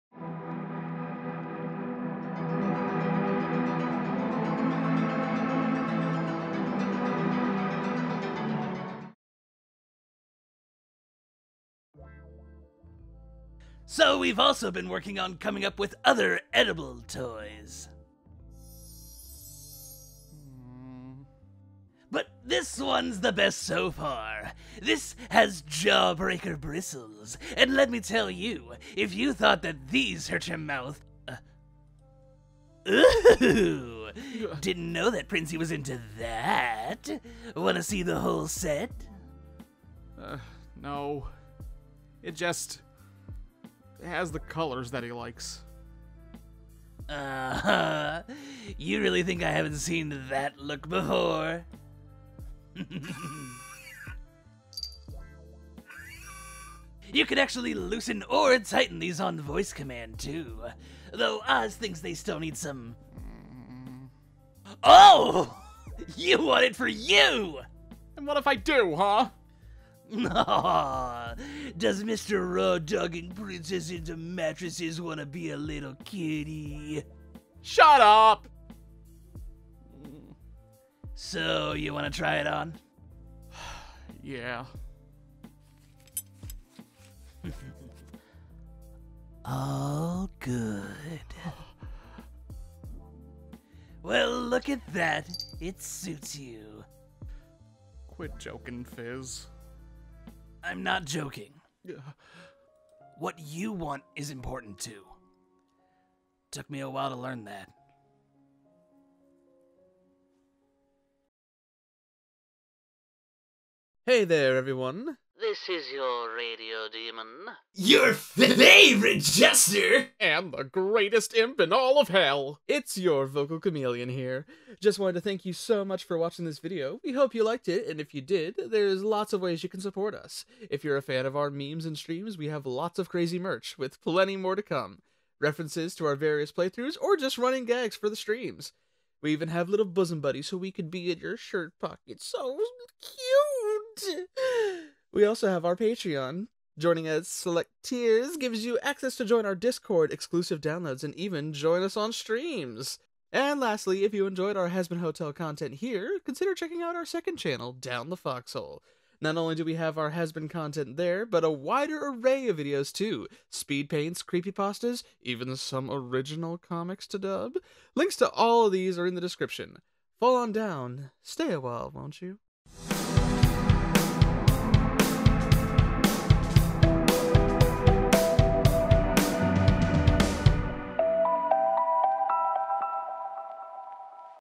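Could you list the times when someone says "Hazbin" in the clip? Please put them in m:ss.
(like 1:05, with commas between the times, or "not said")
2:34, 2:40.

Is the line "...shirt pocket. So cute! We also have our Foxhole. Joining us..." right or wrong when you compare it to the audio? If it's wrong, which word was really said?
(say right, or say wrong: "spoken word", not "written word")
wrong: "Patreon", not "Foxhole".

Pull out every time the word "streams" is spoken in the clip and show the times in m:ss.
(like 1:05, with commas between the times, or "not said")
2:11, 2:18, 2:32.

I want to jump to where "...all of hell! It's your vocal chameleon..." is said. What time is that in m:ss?
2:01.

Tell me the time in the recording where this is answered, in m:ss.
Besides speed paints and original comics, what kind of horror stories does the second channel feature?
2:44.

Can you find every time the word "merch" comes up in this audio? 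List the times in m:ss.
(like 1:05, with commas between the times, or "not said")
2:13.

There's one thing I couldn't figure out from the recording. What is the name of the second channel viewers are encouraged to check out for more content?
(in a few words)
Down the Foxhole.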